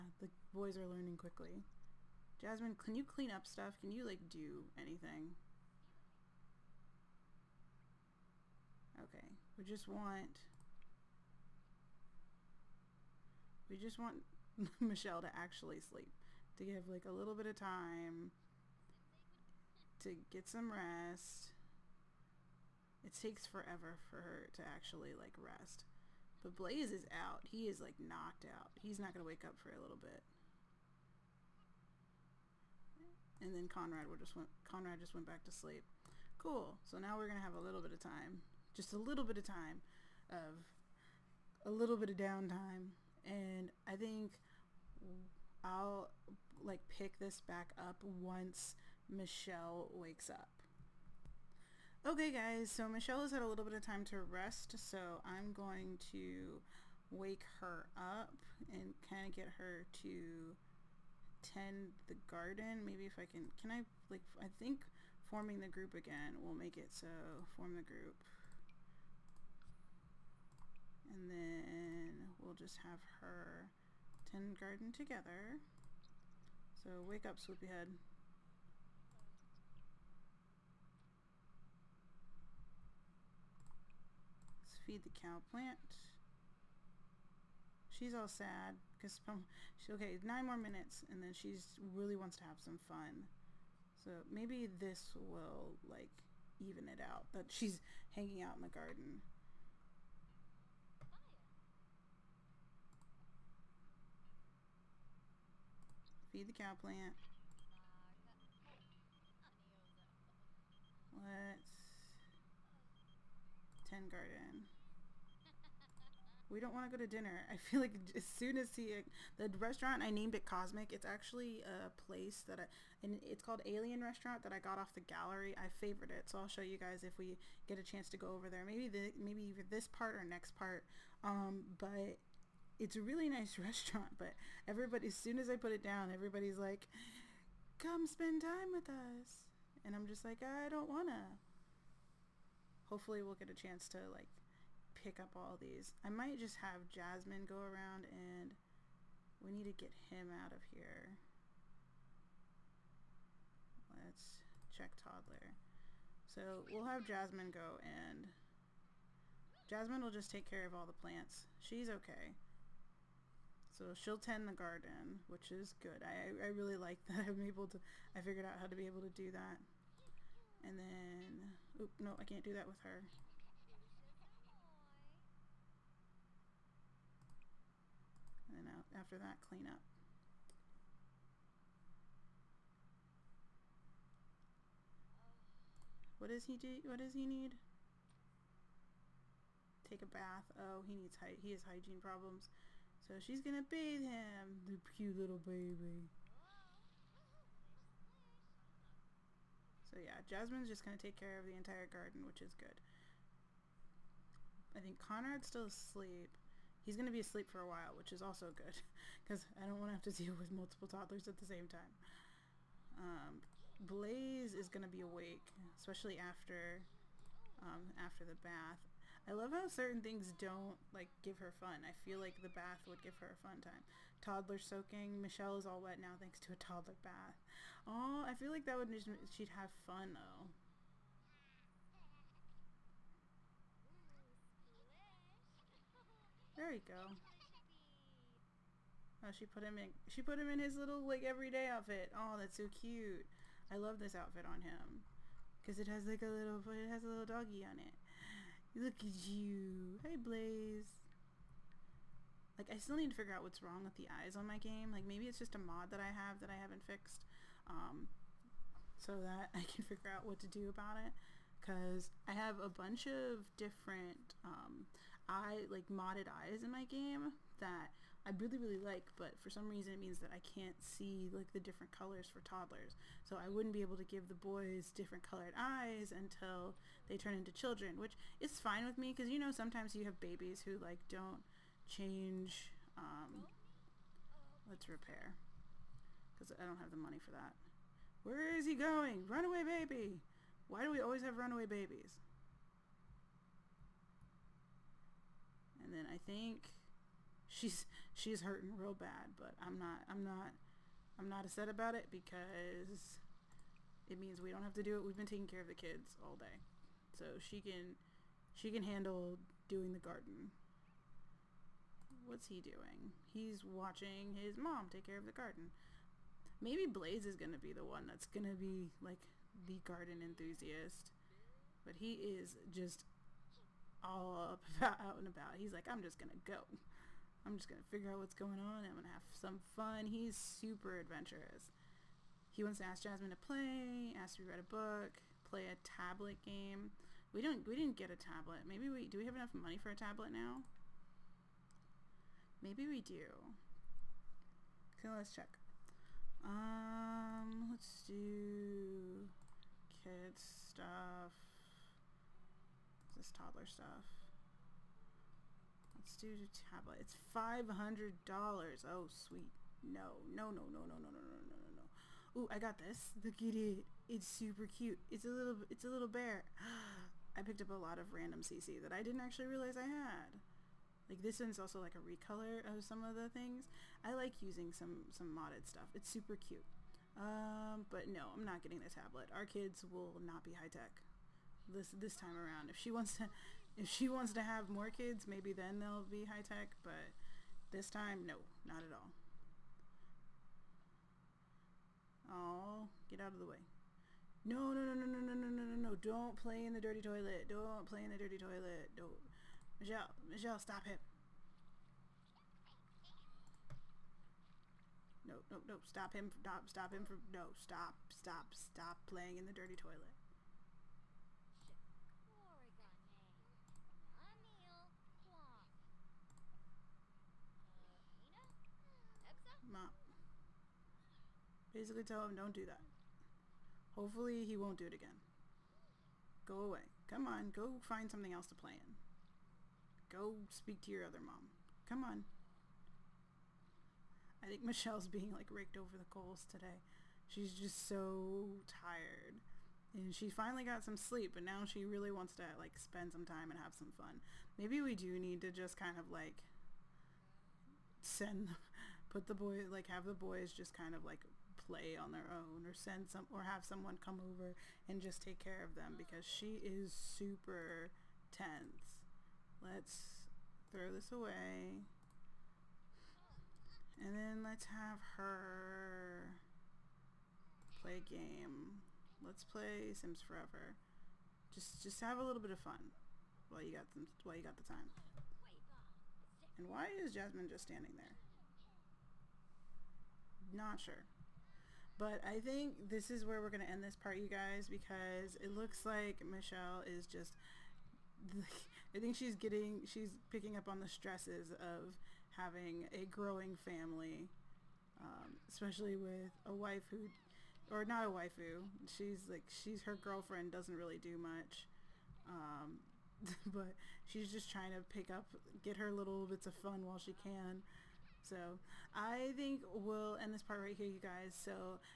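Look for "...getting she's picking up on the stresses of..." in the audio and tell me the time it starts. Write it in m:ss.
8:09.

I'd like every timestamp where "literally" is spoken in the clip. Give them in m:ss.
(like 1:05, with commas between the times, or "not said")
not said.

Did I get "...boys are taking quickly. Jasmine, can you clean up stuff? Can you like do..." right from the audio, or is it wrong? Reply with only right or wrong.
wrong.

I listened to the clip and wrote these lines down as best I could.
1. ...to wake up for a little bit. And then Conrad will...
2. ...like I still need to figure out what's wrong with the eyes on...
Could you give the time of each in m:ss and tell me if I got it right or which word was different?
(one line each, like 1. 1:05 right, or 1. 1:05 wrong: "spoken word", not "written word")
1. 0:29 right
2. 4:12 right.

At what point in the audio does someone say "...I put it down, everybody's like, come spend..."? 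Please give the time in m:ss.
2:15.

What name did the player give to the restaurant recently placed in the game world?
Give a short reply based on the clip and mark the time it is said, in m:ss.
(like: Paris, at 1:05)
Cosmic, at 2:00.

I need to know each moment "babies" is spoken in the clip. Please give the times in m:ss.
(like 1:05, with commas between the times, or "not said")
4:40, 4:51.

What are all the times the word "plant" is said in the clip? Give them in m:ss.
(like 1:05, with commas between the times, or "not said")
1:25, 1:46, 2:40.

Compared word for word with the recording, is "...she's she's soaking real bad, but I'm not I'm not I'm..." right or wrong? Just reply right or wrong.
wrong.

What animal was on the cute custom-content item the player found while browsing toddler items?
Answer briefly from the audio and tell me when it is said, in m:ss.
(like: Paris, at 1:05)
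bear, at 6:05.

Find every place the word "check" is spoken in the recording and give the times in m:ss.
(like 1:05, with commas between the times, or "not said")
2:34, 5:45.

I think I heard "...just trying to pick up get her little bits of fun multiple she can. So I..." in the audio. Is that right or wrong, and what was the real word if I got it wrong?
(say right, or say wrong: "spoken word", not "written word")
wrong: "while", not "multiple".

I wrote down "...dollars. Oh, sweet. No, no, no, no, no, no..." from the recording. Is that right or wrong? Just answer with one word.
right.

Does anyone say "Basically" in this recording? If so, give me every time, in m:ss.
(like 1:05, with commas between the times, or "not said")
7:01.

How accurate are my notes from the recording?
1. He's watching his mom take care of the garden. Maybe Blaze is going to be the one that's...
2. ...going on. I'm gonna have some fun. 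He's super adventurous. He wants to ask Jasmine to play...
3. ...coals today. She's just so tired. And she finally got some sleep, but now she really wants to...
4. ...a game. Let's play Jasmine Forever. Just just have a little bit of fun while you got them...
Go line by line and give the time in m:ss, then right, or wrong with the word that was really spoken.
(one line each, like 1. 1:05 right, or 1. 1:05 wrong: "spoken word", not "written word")
1. 5:13 right
2. 5:28 right
3. 7:16 right
4. 7:47 wrong: "Sims", not "Jasmine".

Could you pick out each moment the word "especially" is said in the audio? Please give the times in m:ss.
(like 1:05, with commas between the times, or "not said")
3:35, 8:15.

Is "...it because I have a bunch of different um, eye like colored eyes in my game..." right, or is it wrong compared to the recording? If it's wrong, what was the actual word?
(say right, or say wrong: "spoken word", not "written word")
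wrong: "modded", not "colored".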